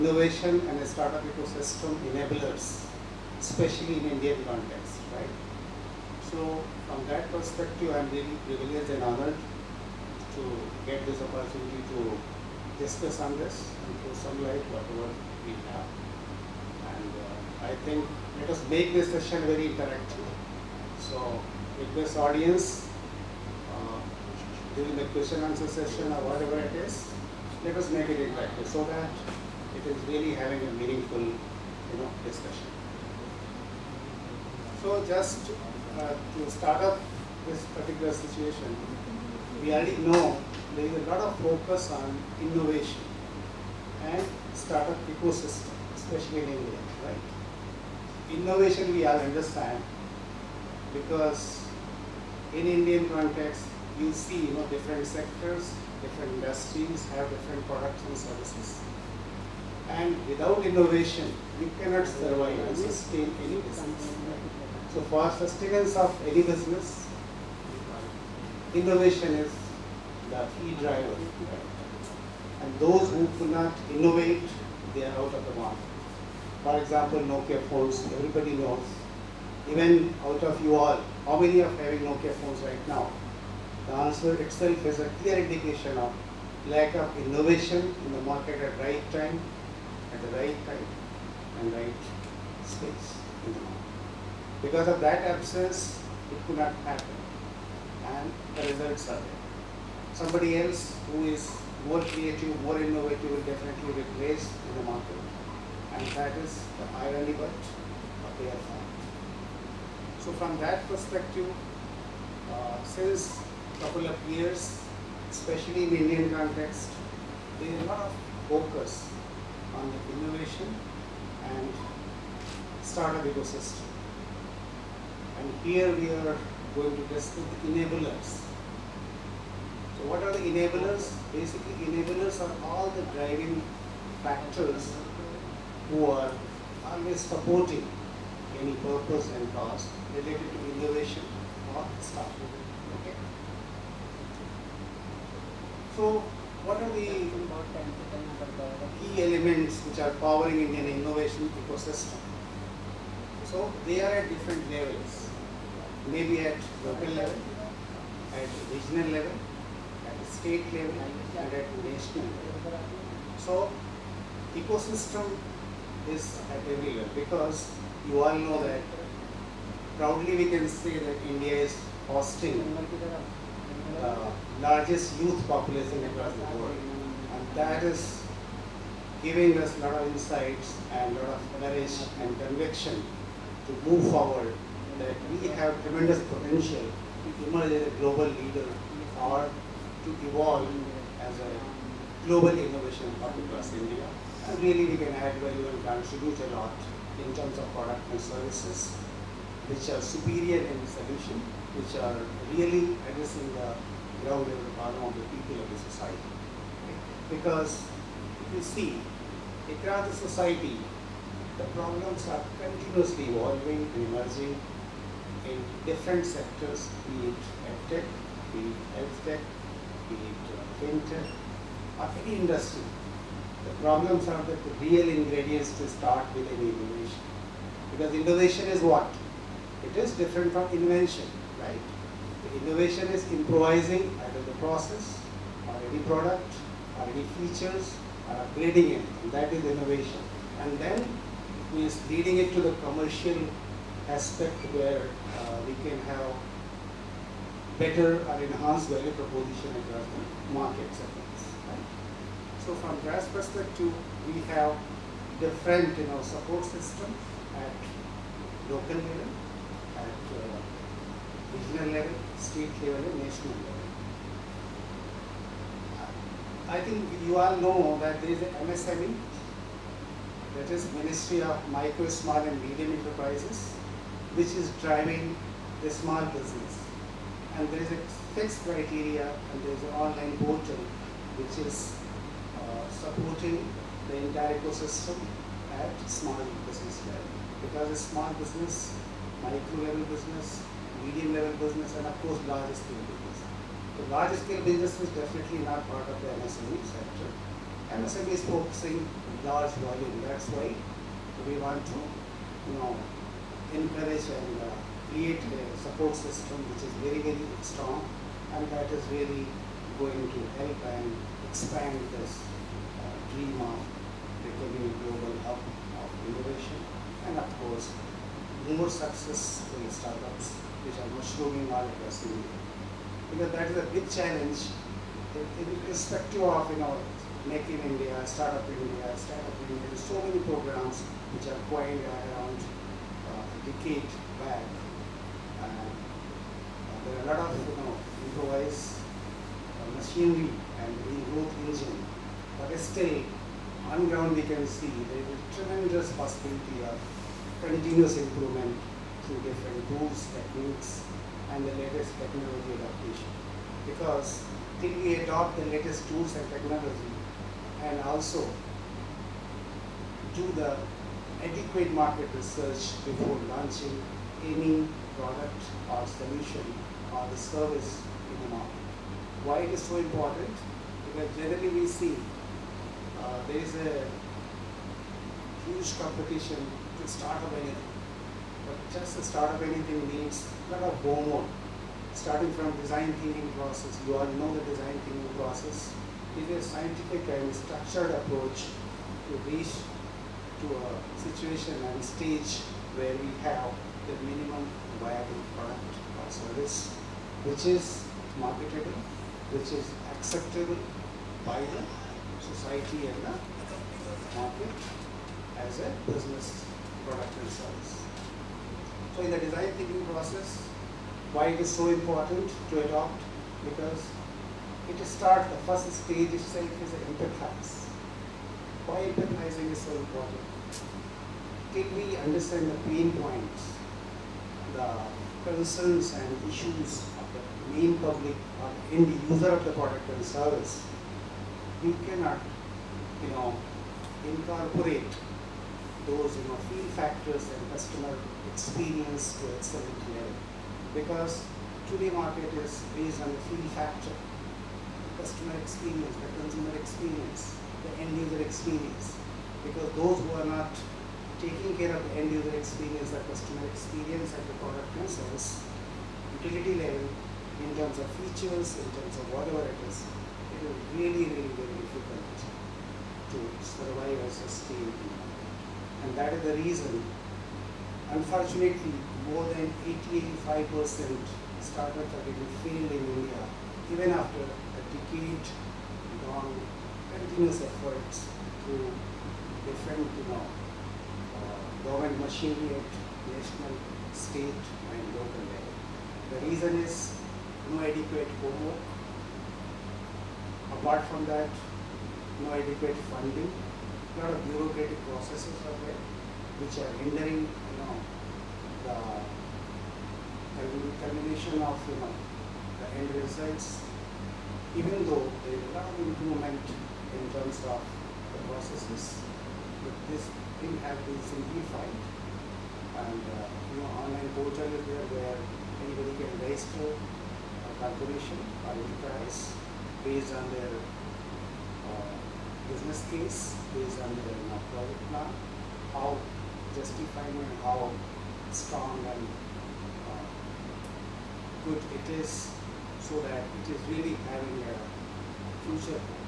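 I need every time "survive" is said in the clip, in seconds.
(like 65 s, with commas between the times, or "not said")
62 s, 463 s.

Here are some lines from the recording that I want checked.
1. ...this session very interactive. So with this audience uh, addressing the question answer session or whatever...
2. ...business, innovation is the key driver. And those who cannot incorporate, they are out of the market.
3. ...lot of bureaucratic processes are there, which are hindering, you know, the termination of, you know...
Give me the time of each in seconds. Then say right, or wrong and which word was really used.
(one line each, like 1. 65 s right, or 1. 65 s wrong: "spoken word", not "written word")
1. 18 s wrong: "during", not "addressing"
2. 66 s wrong: "innovate", not "incorporate"
3. 494 s right.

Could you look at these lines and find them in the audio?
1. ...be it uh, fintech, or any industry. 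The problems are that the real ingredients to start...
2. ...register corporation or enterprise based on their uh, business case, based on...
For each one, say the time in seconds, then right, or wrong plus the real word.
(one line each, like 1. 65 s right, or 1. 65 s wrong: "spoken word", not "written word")
1. 220 s right
2. 516 s right.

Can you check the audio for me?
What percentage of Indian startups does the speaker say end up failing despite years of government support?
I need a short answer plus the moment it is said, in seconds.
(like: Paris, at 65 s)
more than 85 percent, at 469 s.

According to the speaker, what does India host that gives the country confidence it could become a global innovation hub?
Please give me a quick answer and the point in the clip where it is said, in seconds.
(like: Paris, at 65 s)
largest youth population, at 174 s.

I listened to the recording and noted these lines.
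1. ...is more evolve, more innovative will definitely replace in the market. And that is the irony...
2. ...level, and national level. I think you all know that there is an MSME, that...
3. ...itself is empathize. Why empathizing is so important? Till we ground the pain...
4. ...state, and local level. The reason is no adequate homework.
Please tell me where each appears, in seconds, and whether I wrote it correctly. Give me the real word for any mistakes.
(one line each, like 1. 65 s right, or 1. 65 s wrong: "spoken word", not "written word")
1. 101 s wrong: "creative", not "evolve"
2. 262 s right
3. 416 s wrong: "understand", not "ground"
4. 484 s right.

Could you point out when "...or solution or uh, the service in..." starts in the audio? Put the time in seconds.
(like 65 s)
365 s.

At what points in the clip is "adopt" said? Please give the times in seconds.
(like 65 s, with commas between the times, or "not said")
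355 s, 412 s.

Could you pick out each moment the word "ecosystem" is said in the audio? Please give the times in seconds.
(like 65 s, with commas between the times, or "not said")
1 s, 45 s, 123 s, 151 s, 164 s, 284 s.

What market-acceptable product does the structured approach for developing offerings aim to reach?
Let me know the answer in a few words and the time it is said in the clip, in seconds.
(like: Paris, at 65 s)
minimum viable product, at 394 s.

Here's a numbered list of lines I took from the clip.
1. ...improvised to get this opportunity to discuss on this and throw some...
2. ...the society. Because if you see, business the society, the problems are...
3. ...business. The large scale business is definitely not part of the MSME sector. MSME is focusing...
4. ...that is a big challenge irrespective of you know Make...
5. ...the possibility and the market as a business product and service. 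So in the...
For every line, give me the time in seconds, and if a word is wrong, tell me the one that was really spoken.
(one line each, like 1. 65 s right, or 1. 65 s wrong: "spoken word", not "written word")
1. 9 s wrong: "honored", not "improvised"
2. 205 s wrong: "across", not "business"
3. 293 s right
4. 323 s right
5. 401 s wrong: "society", not "possibility".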